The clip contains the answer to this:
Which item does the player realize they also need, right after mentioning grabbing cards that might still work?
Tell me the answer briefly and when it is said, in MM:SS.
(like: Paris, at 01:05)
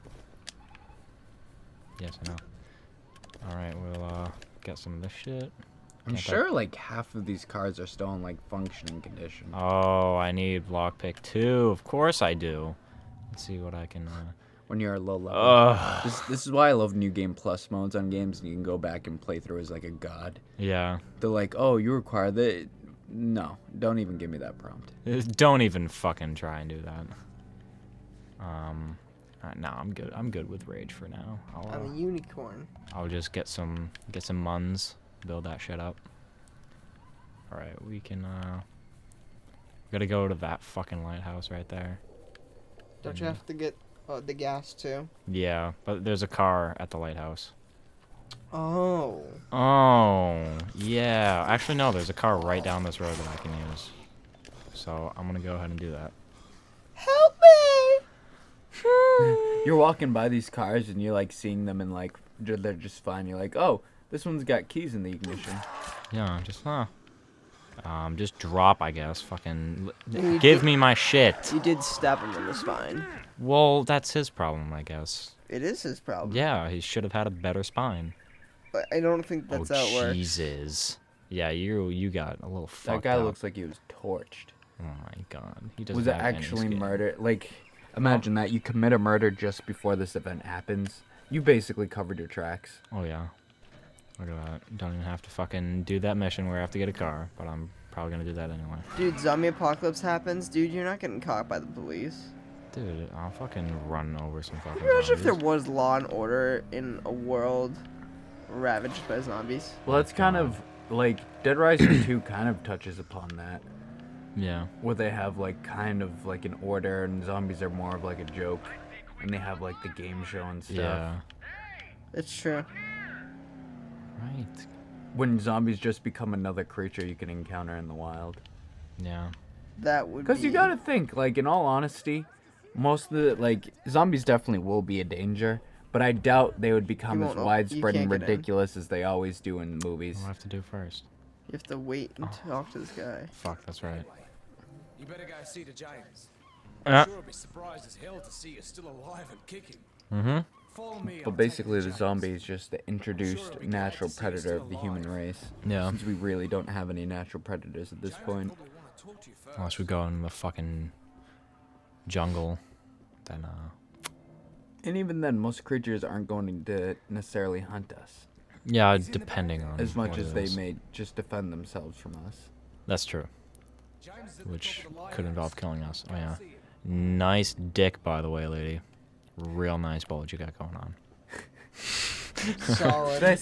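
Lockpick, at 00:10.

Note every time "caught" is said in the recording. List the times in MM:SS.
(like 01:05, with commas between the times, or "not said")
01:41.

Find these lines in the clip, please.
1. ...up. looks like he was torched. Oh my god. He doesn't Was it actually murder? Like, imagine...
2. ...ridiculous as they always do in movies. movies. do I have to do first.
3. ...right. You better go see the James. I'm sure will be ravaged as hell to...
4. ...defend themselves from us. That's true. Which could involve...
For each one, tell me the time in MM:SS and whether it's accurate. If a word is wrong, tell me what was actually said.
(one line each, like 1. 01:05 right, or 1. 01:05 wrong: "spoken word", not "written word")
1. 01:23 right
2. 02:18 right
3. 02:23 wrong: "surprised", not "ravaged"
4. 02:51 right.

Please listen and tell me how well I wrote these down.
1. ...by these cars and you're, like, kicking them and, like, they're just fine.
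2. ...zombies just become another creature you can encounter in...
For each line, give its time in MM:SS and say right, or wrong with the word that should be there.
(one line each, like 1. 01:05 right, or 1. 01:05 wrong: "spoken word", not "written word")
1. 01:00 wrong: "seeing", not "kicking"
2. 02:05 right.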